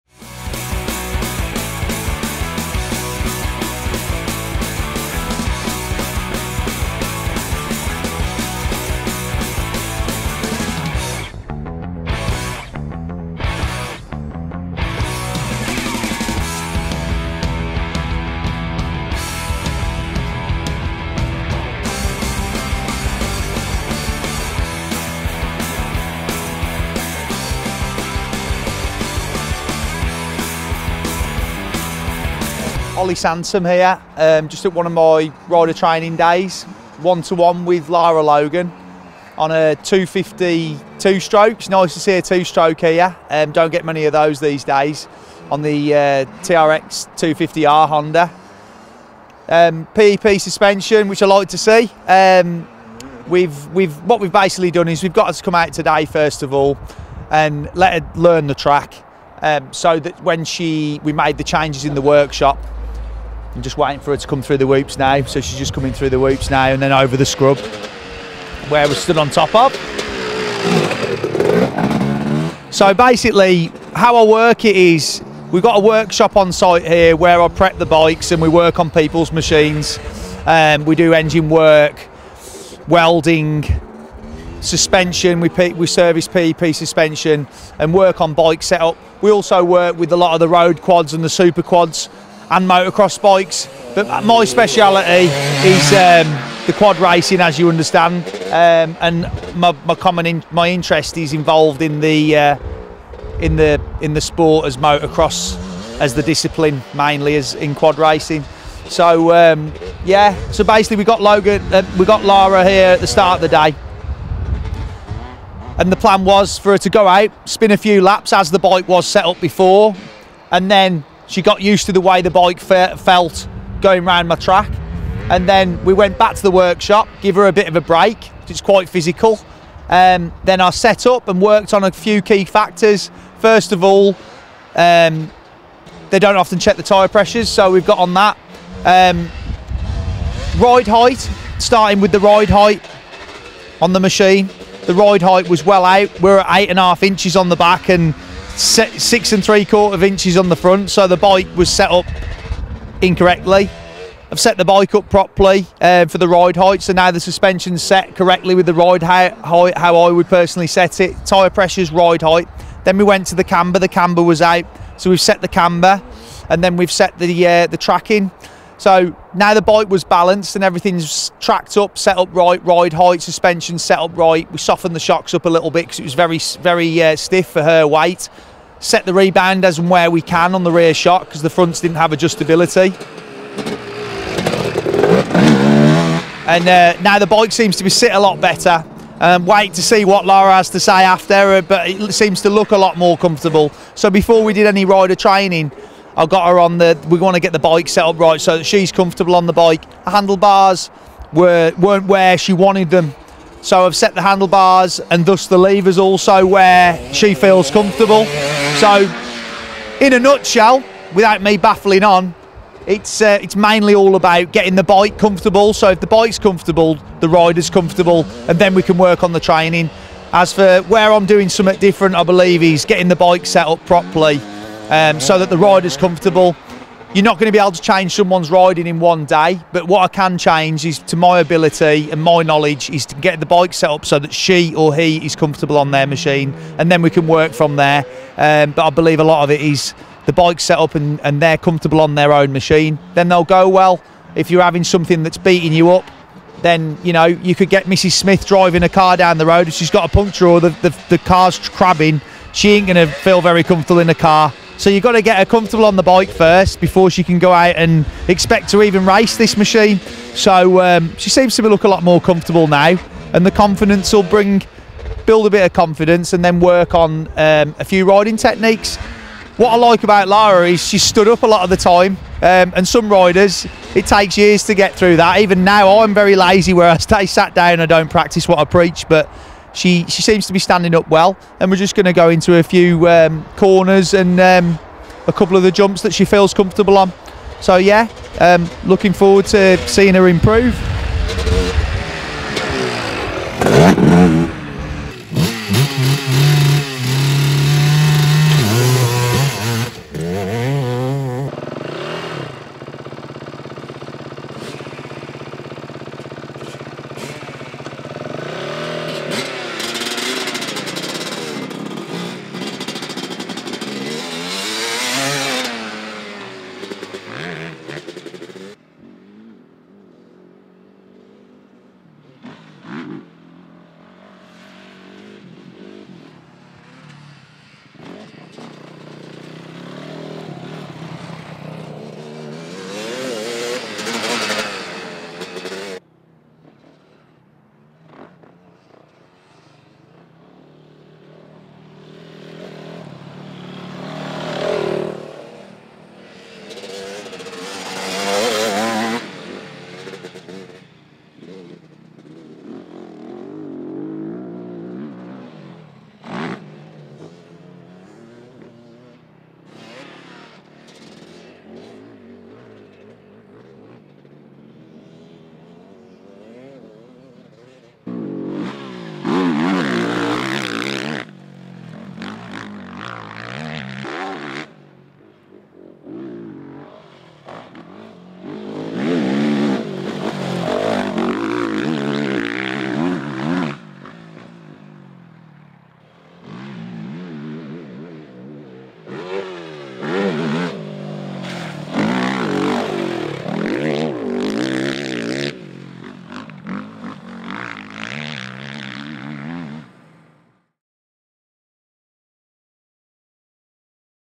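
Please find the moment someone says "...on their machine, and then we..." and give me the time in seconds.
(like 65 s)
235 s.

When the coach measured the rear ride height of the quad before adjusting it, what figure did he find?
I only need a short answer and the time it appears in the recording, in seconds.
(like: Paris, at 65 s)
8.5 inches, at 146 s.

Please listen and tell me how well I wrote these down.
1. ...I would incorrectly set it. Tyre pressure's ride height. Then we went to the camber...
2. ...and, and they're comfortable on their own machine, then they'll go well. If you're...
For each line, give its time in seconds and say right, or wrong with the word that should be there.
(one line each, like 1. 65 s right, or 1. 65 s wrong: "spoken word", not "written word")
1. 159 s wrong: "personally", not "incorrectly"
2. 240 s right.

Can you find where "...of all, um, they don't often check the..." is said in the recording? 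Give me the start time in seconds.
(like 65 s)
133 s.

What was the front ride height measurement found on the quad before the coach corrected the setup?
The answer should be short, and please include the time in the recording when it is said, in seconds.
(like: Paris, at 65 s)
6 3/4 inches, at 148 s.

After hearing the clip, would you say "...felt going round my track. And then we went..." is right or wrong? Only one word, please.
right.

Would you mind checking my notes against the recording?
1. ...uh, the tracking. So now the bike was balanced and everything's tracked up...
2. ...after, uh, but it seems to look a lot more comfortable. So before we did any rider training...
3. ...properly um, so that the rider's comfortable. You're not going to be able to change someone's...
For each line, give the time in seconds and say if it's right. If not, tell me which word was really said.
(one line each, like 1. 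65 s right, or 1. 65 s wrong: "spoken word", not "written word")
1. 167 s right
2. 191 s right
3. 223 s right.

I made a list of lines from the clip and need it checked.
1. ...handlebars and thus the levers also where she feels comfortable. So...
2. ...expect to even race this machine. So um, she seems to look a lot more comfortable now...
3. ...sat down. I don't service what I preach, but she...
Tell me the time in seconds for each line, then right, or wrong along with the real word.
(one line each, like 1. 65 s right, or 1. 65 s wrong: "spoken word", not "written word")
1. 204 s right
2. 258 s right
3. 277 s wrong: "practice", not "service".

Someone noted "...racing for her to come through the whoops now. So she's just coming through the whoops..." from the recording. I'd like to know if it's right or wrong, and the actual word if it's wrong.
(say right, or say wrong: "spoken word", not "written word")
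wrong: "waiting", not "racing".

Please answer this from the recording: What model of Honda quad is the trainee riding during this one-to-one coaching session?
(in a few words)
TRX 250R.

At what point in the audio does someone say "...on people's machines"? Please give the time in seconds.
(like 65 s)
78 s.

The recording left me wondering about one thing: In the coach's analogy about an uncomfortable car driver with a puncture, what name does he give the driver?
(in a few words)
Mrs. Smith.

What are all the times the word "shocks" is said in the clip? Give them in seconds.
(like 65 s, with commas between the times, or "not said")
174 s, 180 s.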